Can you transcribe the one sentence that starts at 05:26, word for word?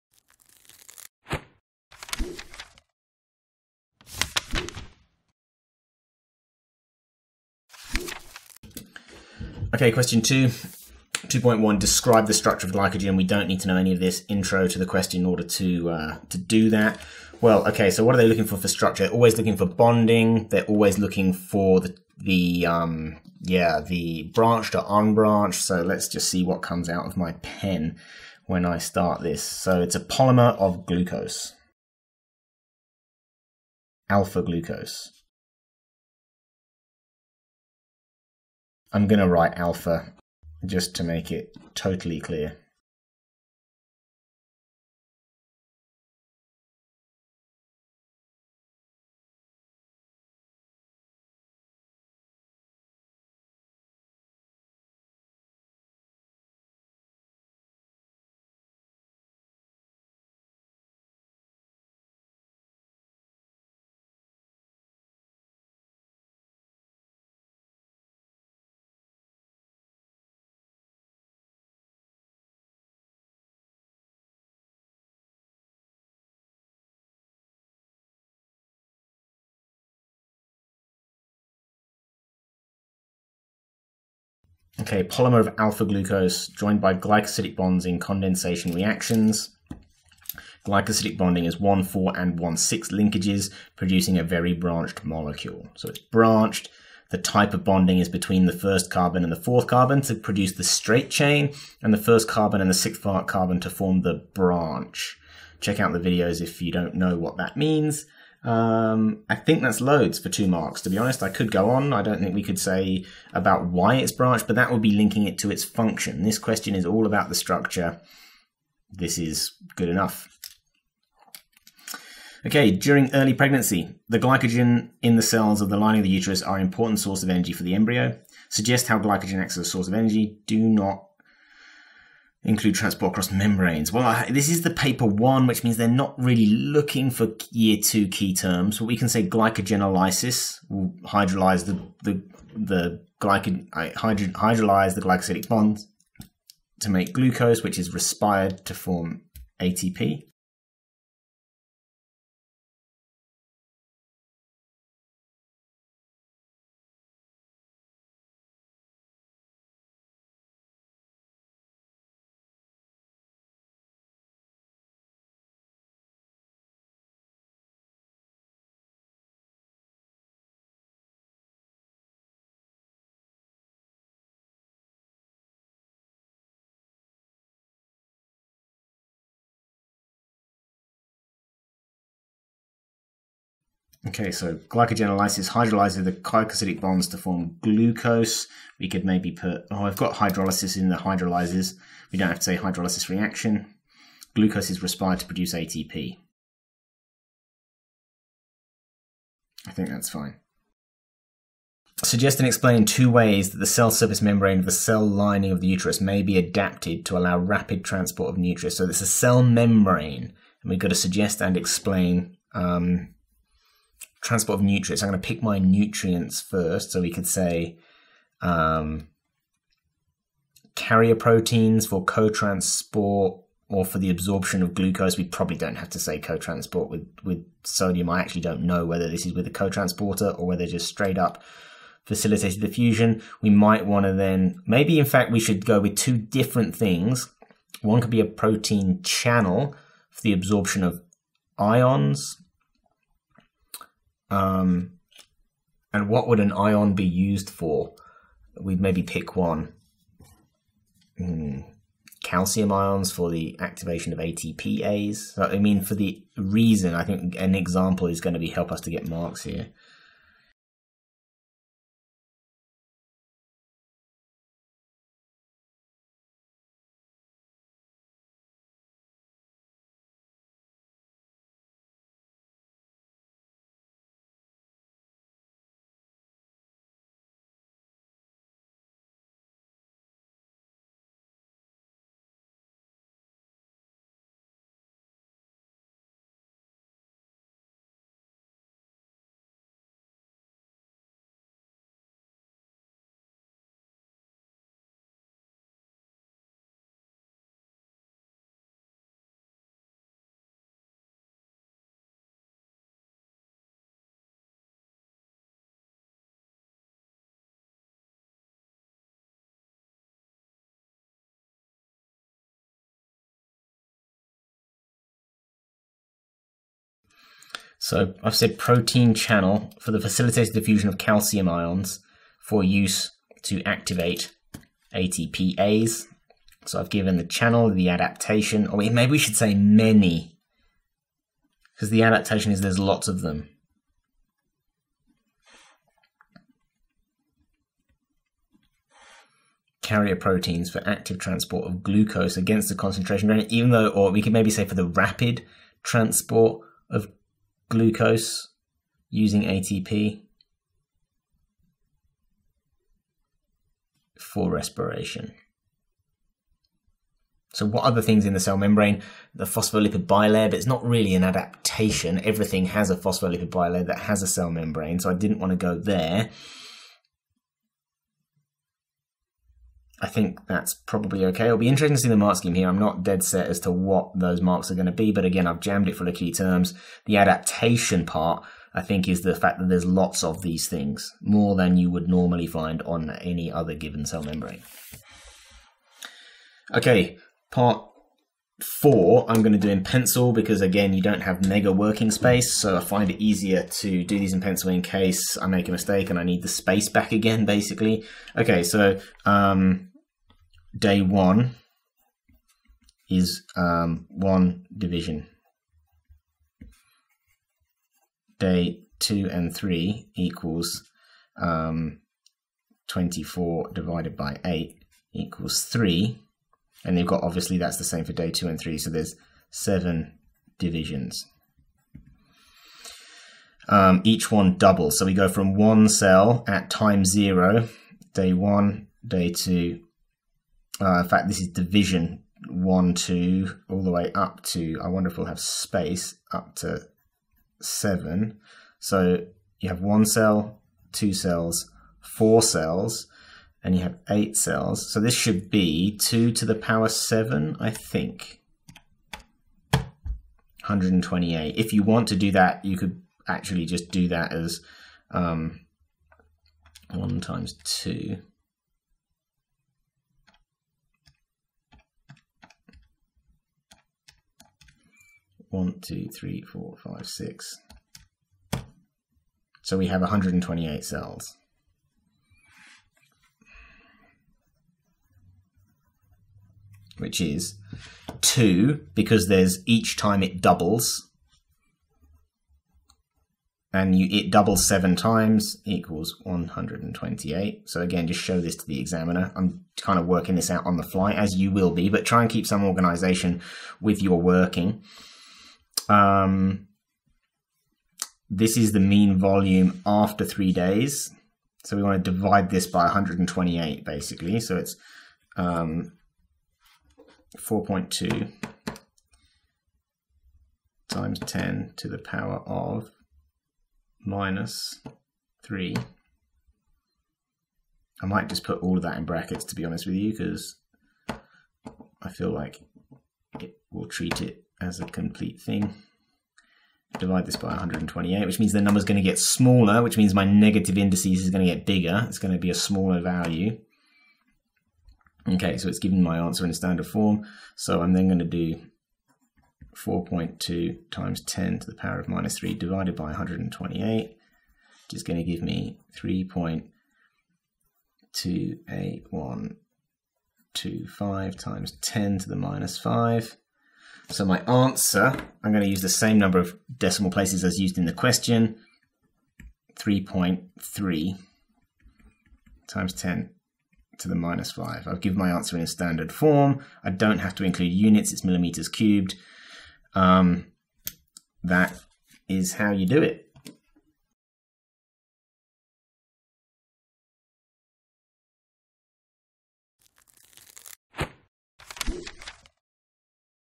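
So I've given the channel, the adaptation, or maybe we should say many, because the adaptation is there's lots of them.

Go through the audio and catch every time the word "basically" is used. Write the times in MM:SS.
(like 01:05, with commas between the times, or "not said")
06:37, 08:23.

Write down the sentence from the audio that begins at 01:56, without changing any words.
This question is all about the structure.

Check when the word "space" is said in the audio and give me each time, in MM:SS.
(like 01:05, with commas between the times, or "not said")
06:32, 06:36, 07:15.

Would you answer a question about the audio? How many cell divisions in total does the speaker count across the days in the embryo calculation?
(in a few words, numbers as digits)
7.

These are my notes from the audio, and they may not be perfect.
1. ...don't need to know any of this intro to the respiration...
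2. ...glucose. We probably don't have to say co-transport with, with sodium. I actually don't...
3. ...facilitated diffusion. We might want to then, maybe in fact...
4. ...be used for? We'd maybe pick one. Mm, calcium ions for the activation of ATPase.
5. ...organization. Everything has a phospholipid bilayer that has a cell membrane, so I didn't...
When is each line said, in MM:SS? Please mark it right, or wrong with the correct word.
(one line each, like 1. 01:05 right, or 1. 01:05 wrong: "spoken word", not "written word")
1. 00:13 wrong: "question", not "respiration"
2. 03:44 right
3. 03:52 right
4. 04:06 right
5. 06:01 wrong: "adaptation", not "organization".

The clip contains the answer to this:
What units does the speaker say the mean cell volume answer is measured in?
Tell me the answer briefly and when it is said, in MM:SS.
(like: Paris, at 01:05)
millimeters cubed, at 09:28.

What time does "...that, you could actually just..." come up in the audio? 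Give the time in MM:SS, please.
07:32.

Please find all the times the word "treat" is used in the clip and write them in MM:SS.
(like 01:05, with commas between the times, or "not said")
08:43.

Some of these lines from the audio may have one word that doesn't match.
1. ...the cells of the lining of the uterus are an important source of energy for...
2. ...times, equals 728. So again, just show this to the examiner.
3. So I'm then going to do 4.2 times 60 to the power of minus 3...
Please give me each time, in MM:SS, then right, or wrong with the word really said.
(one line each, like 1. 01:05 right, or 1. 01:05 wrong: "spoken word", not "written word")
1. 02:05 right
2. 08:04 wrong: "128", not "728"
3. 08:57 wrong: "10", not "60".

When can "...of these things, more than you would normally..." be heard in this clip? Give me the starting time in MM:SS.
06:20.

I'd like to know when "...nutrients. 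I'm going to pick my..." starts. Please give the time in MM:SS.
03:34.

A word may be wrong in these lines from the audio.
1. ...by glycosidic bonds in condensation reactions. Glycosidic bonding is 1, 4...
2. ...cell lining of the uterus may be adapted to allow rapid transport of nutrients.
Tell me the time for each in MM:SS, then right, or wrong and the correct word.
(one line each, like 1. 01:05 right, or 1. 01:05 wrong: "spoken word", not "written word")
1. 01:26 right
2. 03:24 right.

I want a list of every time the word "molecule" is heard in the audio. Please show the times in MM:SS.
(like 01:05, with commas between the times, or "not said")
01:35.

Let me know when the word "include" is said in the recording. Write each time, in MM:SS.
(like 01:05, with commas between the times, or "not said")
02:12, 09:27.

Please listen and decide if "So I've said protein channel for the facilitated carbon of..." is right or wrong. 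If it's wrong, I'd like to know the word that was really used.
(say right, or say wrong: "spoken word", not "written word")
wrong: "diffusion", not "carbon".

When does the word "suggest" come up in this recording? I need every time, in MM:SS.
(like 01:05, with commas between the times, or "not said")
02:08, 03:22, 03:30.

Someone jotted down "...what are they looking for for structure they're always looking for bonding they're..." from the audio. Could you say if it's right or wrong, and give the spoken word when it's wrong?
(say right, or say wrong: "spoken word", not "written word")
right.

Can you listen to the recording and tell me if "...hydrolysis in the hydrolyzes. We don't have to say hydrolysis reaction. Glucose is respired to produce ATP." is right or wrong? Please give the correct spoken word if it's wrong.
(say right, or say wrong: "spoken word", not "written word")
right.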